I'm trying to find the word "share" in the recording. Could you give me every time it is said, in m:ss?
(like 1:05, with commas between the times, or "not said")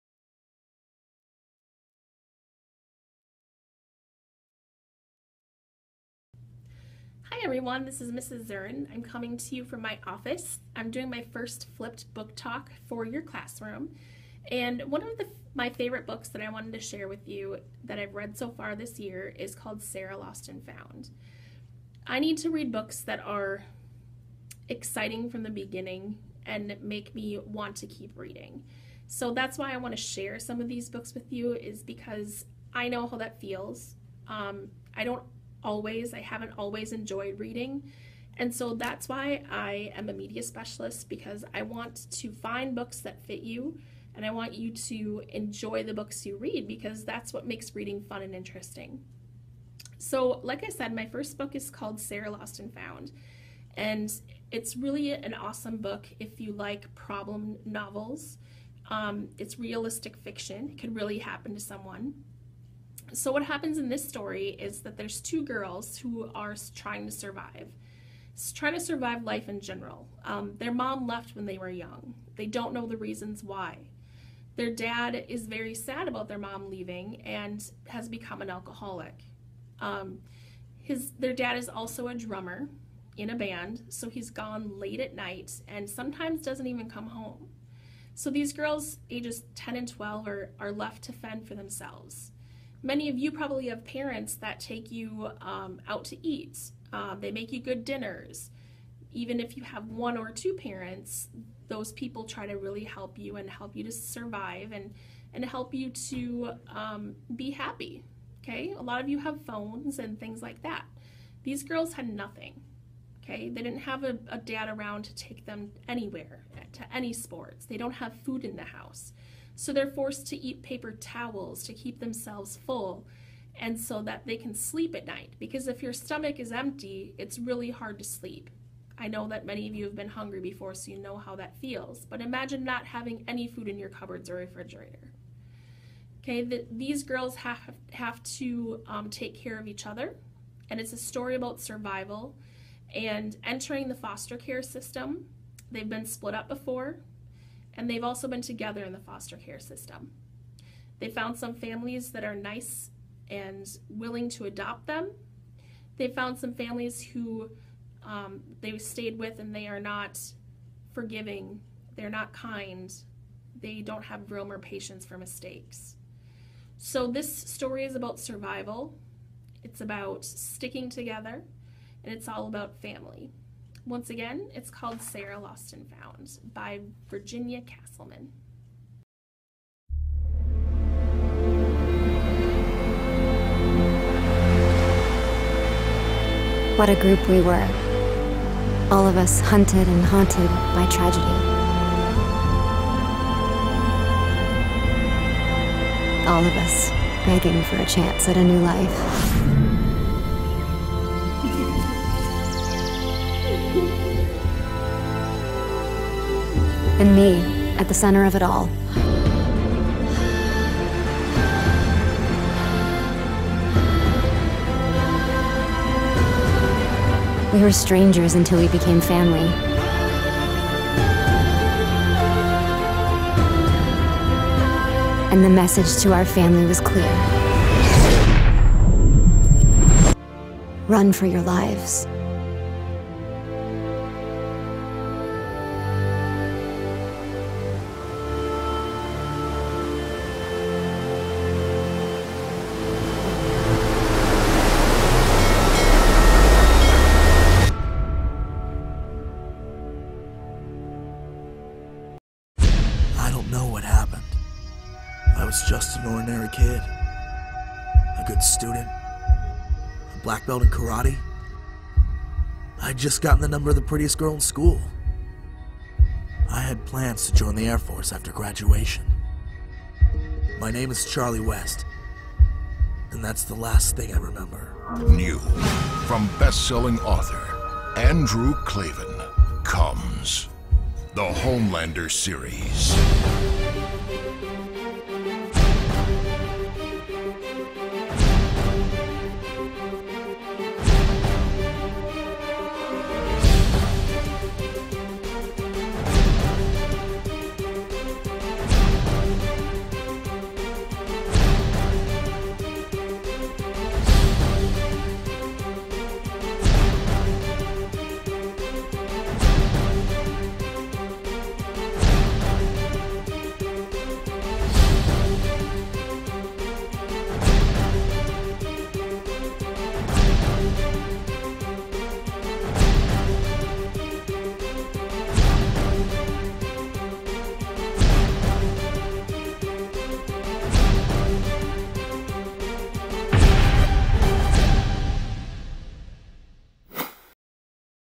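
0:16, 0:30.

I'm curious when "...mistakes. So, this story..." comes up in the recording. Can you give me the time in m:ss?
2:45.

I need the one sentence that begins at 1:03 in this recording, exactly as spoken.
So what happens in this story is that there's two girls who are trying to survive, trying to survive life in general.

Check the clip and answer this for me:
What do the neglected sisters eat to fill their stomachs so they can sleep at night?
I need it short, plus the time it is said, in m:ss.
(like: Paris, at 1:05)
Paper towels, at 2:00.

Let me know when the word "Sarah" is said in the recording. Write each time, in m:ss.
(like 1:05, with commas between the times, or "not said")
0:19, 0:51, 2:55.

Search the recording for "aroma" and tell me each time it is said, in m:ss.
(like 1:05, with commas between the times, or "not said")
not said.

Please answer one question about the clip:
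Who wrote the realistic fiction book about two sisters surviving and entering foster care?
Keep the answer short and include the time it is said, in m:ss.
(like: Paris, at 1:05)
Virginia Castleman, at 2:57.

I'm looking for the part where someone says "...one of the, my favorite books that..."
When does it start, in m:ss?
0:14.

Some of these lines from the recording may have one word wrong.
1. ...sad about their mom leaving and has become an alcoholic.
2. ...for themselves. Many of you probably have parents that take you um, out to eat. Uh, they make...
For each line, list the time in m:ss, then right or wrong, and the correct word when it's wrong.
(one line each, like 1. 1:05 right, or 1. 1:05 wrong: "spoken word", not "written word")
1. 1:15 right
2. 1:31 right.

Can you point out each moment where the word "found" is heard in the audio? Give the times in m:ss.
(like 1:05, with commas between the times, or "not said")
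0:20, 0:52, 2:31, 2:36, 2:55.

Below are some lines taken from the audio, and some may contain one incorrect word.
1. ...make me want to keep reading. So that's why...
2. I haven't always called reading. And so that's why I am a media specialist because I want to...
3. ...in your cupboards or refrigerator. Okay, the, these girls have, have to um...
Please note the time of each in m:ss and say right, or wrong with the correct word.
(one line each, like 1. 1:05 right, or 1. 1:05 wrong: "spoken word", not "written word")
1. 0:26 right
2. 0:36 wrong: "enjoyed", not "called"
3. 2:13 right.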